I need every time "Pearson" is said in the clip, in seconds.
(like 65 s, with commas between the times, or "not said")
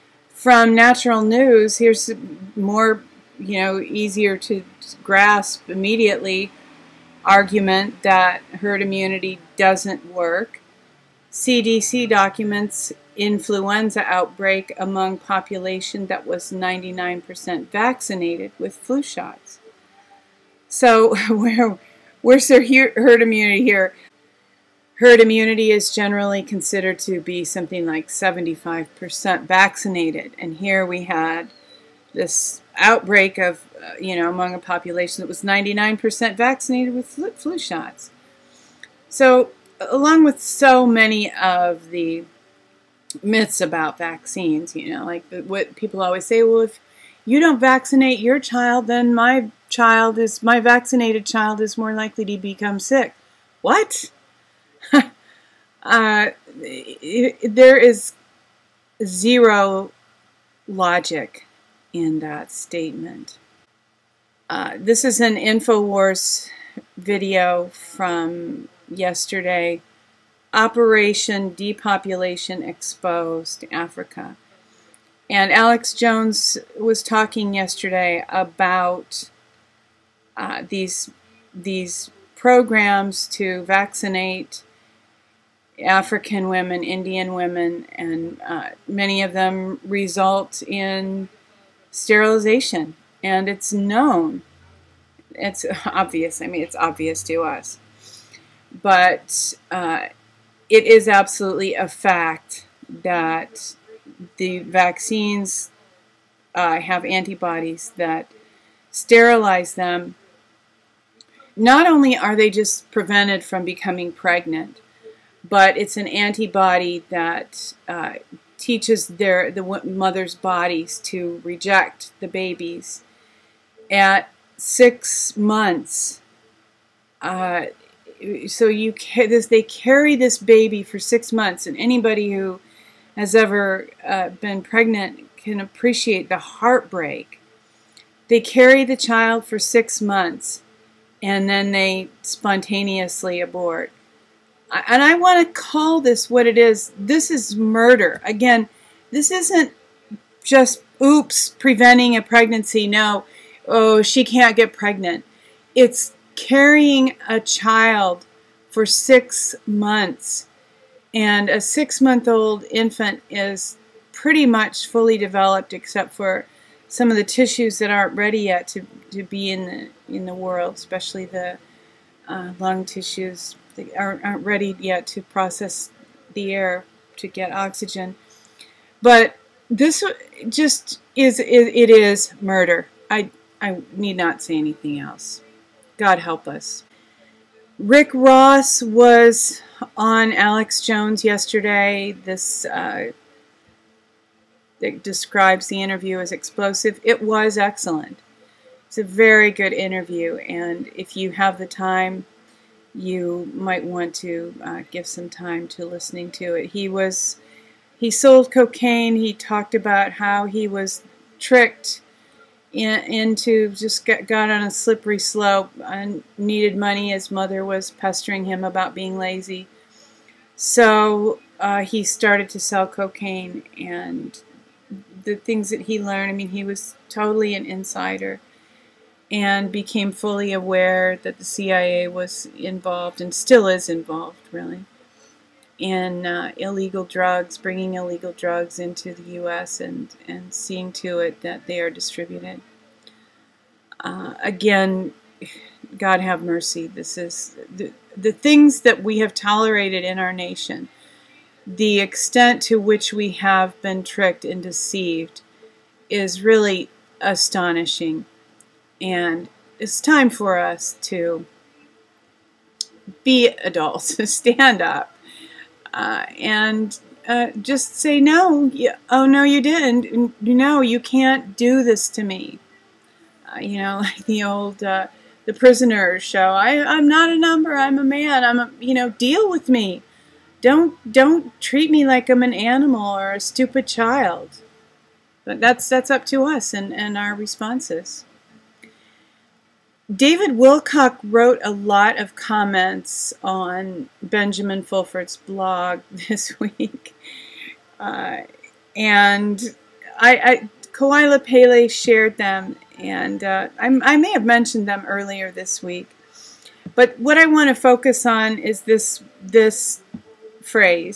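not said.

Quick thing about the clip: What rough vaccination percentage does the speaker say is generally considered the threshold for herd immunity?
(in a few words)
75%.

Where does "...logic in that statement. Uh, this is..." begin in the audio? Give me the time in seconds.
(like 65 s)
60 s.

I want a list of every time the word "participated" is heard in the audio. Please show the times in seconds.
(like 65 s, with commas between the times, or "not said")
not said.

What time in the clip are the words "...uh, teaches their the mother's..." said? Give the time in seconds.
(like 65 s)
117 s.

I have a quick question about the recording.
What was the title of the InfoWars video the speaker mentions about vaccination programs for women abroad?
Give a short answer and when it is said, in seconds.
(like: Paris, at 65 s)
Operation Depopulation Exposed, at 70 s.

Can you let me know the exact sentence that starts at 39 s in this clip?
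So along with so many of the myths about vaccines.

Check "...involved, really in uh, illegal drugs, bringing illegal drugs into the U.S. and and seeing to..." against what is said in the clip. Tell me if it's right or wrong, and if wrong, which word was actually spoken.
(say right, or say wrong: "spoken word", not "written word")
right.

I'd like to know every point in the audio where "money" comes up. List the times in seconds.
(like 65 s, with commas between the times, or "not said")
216 s.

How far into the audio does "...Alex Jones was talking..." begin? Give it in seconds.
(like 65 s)
75 s.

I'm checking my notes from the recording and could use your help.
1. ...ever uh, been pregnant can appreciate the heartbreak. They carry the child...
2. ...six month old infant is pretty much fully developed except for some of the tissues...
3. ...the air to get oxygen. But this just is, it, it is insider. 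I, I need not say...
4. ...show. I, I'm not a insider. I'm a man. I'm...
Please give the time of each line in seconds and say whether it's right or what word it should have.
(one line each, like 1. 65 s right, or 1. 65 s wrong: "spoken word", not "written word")
1. 133 s right
2. 161 s right
3. 176 s wrong: "murder", not "insider"
4. 276 s wrong: "number", not "insider".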